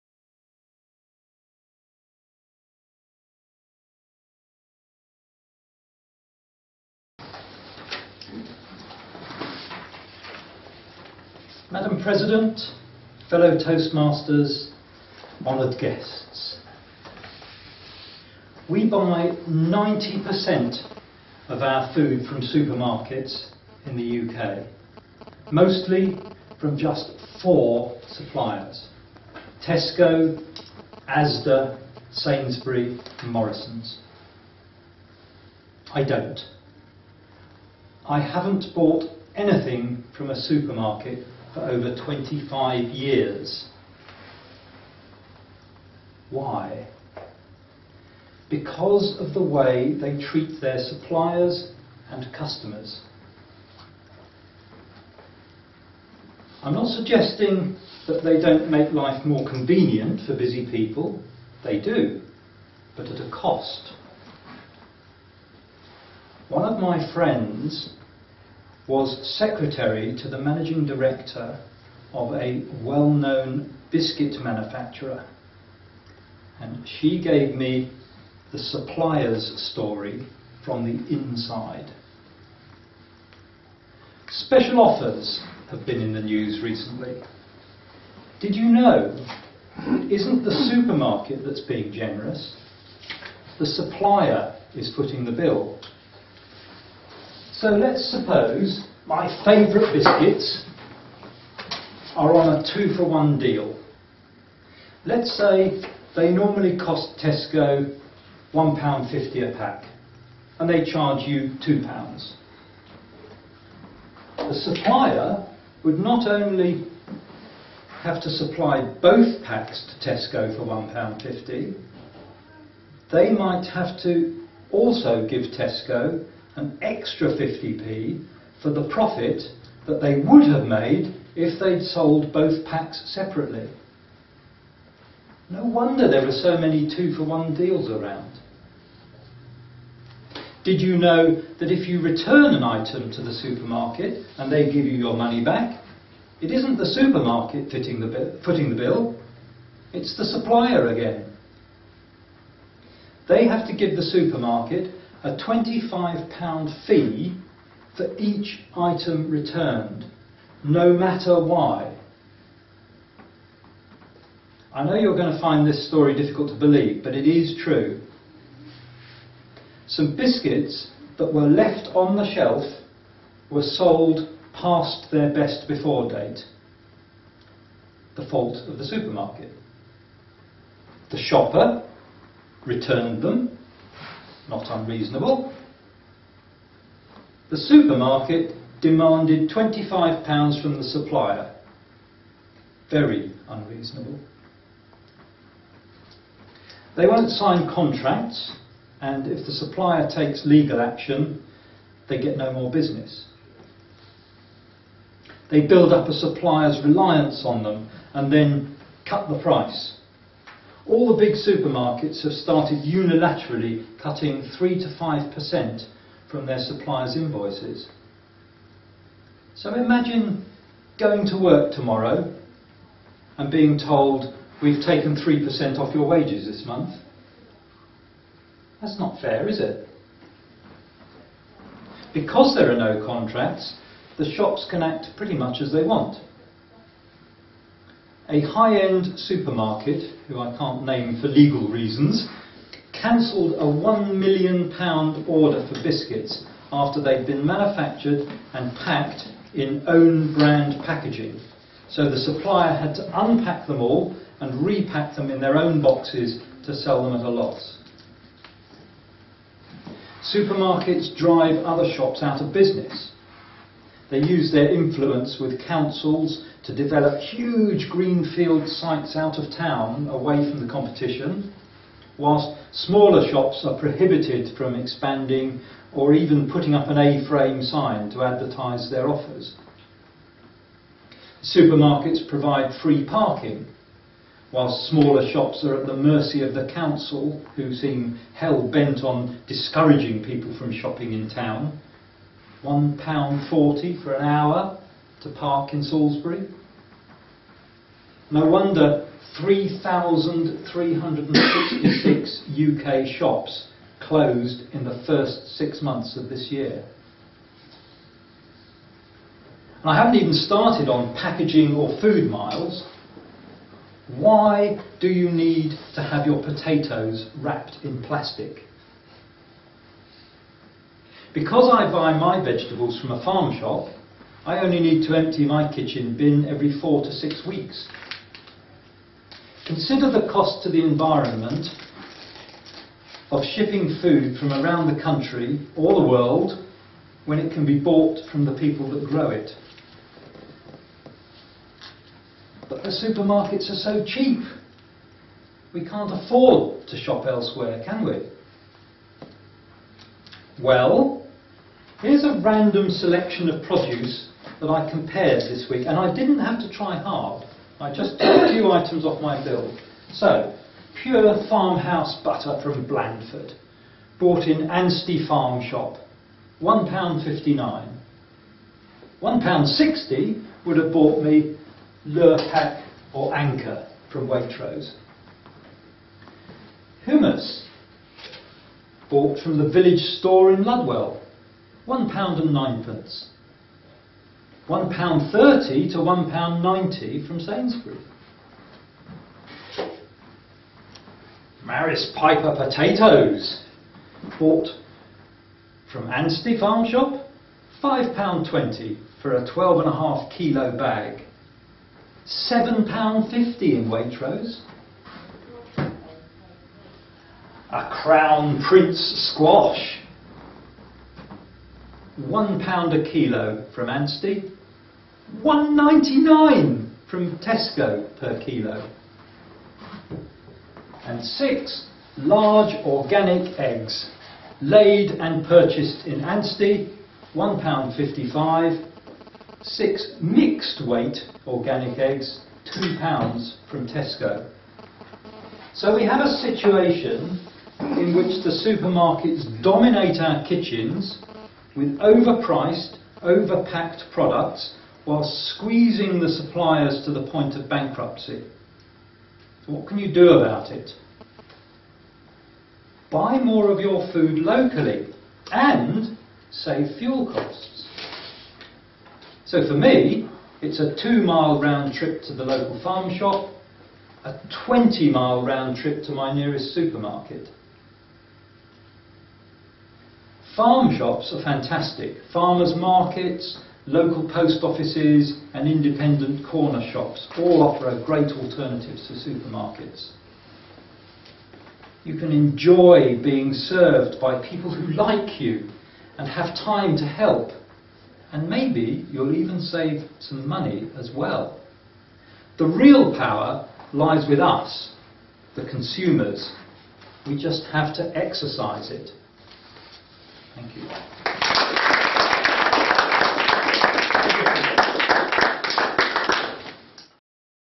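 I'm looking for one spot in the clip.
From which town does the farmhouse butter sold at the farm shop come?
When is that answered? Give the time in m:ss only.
6:02.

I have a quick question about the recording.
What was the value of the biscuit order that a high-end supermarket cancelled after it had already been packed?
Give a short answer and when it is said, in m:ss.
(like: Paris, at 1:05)
£1 million, at 4:03.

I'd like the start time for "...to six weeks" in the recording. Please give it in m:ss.
5:27.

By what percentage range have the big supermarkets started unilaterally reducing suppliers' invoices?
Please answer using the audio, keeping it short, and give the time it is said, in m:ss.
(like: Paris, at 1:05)
3 to 5%, at 3:34.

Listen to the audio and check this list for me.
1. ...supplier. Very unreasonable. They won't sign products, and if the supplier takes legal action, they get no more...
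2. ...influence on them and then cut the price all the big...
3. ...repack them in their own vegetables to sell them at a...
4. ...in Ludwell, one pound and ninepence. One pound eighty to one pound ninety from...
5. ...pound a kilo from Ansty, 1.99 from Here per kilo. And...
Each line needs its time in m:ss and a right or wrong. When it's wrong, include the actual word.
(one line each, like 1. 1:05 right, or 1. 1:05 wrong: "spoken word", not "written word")
1. 3:10 wrong: "contracts", not "products"
2. 3:26 wrong: "reliance", not "influence"
3. 4:14 wrong: "boxes", not "vegetables"
4. 6:20 wrong: "thirty", not "eighty"
5. 6:52 wrong: "Tesco", not "Here".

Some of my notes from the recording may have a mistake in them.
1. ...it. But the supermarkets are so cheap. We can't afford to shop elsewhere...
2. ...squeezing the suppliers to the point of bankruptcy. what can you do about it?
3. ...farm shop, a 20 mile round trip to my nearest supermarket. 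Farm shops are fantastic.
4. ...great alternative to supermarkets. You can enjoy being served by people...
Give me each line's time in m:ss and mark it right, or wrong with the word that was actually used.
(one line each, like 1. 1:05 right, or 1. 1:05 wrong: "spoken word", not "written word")
1. 5:39 right
2. 7:25 right
3. 7:42 right
4. 7:58 right.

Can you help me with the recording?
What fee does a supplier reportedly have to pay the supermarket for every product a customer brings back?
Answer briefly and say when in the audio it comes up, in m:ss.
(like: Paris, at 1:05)
£25, at 2:35.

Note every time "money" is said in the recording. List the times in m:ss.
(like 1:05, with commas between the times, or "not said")
2:25, 8:10.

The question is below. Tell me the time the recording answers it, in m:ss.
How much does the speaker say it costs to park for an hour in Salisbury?
4:52.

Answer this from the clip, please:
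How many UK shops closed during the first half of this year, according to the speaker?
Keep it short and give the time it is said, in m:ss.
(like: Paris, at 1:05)
3,366, at 4:59.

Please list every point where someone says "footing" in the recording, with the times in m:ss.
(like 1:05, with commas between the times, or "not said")
1:34, 2:28.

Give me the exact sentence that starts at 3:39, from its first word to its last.
So imagine going to work tomorrow and being told, we've taken 3% off your wages this month.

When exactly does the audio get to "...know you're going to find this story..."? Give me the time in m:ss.
2:44.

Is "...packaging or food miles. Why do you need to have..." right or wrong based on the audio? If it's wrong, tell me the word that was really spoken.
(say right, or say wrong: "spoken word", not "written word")
right.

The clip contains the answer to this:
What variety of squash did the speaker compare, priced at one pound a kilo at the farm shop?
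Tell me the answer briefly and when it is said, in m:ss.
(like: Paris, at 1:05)
Crown Prince, at 6:48.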